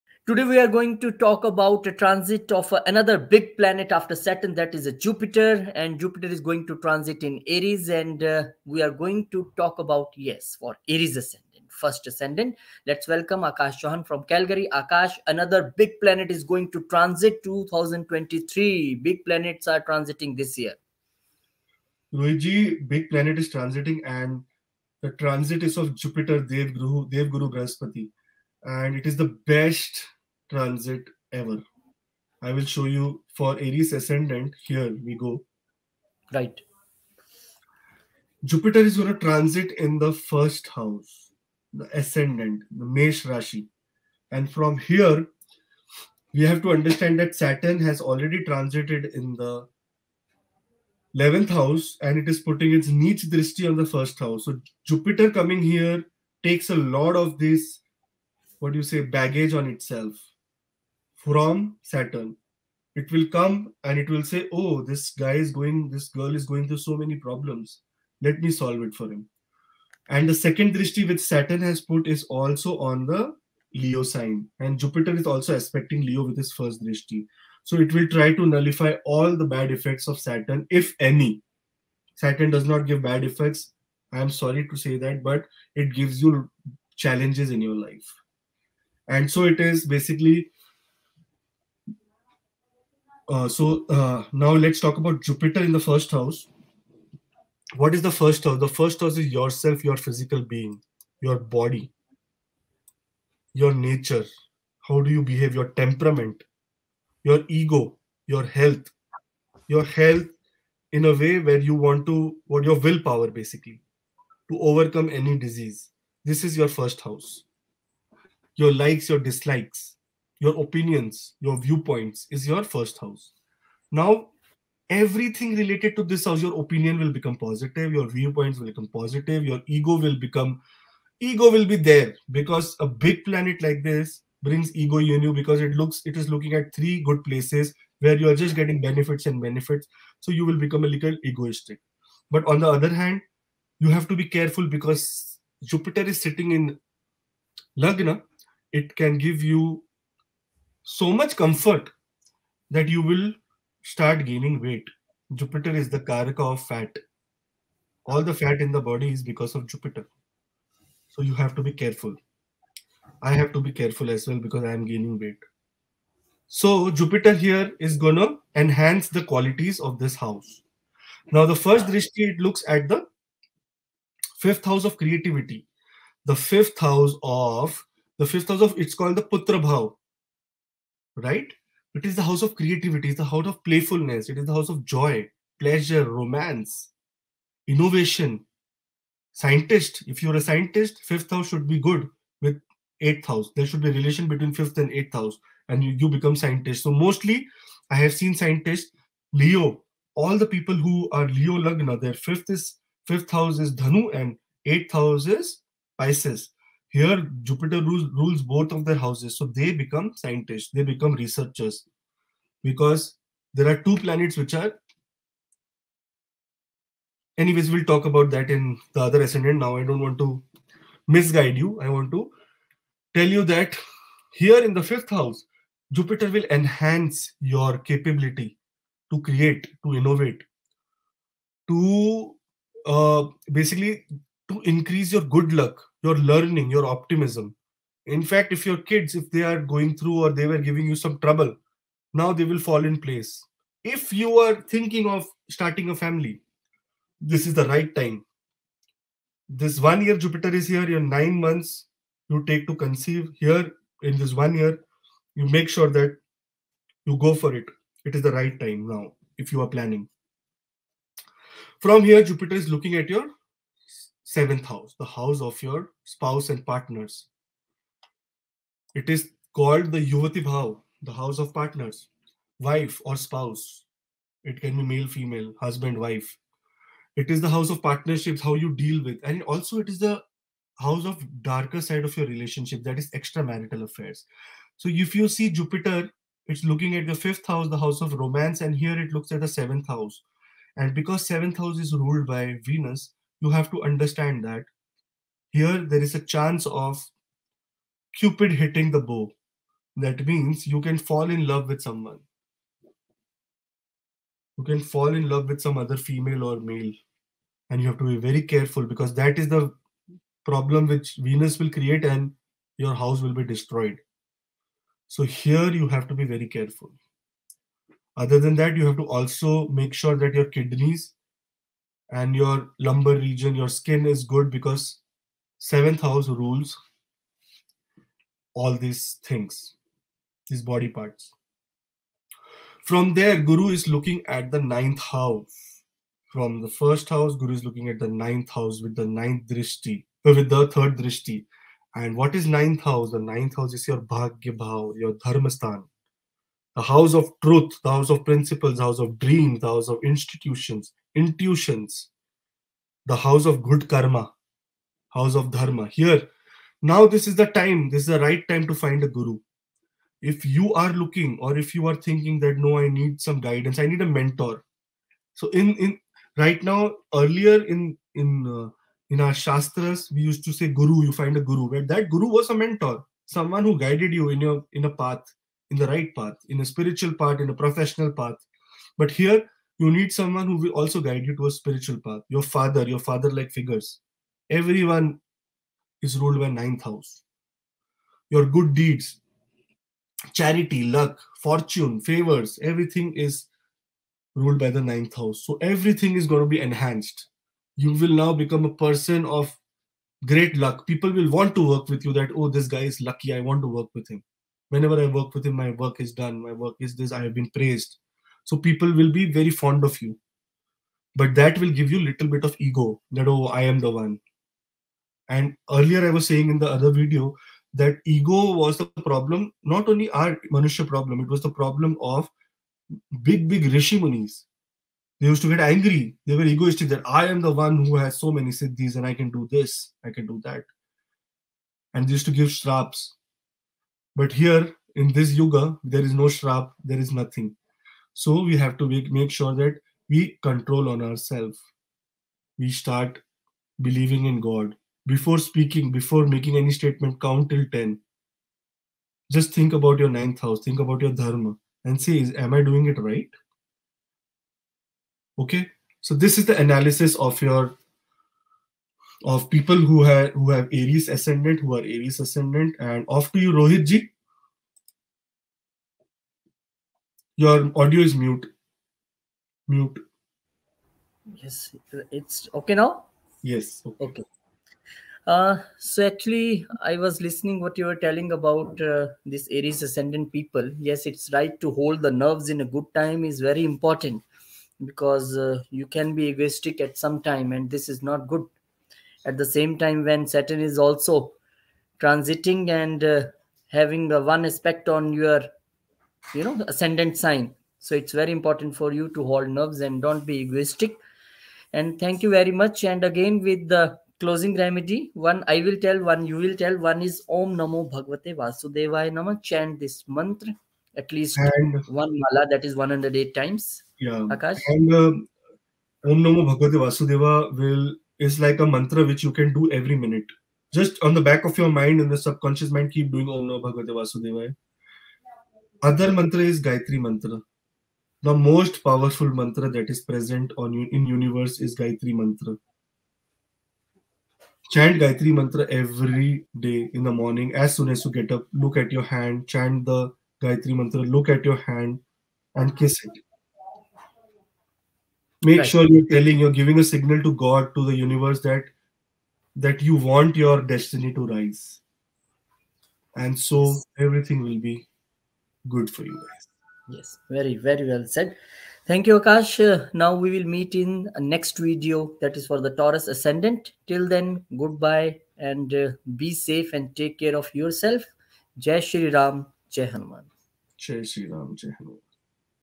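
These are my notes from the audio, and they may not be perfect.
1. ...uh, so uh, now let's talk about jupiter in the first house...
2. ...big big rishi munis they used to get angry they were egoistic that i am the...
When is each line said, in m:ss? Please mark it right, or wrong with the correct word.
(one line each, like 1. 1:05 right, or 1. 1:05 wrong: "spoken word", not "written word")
1. 1:33 right
2. 7:03 right.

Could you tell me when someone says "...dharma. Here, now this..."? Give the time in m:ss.
5:55.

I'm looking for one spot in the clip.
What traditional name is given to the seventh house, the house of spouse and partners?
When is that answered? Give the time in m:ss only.
4:30.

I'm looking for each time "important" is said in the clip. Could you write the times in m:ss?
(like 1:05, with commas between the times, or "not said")
8:03, 8:18.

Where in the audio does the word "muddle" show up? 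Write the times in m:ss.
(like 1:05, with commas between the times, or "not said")
not said.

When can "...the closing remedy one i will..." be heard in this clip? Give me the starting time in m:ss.
8:23.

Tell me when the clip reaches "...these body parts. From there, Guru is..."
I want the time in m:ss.
5:30.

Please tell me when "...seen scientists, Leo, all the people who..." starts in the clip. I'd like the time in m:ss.
3:18.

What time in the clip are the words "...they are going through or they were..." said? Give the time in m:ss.
3:59.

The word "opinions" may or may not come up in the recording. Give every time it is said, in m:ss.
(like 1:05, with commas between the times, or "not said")
2:00, 2:06.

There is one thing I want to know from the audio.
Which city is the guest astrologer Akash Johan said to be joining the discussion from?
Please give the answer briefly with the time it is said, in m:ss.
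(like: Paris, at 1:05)
Calgary, at 0:14.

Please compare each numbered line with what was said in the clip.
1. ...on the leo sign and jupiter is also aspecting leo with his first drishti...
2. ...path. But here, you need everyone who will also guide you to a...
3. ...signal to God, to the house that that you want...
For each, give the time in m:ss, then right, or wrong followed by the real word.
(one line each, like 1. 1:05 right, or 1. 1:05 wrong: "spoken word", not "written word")
1. 1:12 right
2. 6:18 wrong: "someone", not "everyone"
3. 9:06 wrong: "universe", not "house".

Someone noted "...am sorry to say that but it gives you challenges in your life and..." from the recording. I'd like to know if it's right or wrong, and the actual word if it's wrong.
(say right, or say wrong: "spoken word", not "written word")
right.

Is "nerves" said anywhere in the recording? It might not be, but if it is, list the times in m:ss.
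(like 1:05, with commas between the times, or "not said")
8:02, 8:19.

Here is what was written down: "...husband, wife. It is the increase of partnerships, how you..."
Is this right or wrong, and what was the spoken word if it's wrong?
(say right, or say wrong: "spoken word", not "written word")
wrong: "house", not "increase".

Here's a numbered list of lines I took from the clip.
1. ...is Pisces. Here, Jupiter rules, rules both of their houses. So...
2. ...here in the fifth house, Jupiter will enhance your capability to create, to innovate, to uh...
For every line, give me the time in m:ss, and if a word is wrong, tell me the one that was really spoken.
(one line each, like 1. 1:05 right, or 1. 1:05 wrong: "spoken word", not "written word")
1. 3:25 right
2. 3:44 right.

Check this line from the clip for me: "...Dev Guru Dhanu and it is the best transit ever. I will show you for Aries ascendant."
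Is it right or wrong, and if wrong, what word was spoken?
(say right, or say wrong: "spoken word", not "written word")
wrong: "Brahaspati", not "Dhanu".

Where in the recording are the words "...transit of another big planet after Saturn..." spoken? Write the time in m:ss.
0:01.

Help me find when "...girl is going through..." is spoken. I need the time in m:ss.
1:06.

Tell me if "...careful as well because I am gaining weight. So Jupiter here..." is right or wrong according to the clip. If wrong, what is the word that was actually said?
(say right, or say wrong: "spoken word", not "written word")
right.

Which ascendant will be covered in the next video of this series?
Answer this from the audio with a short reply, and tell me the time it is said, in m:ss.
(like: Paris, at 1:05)
Taurus, at 9:22.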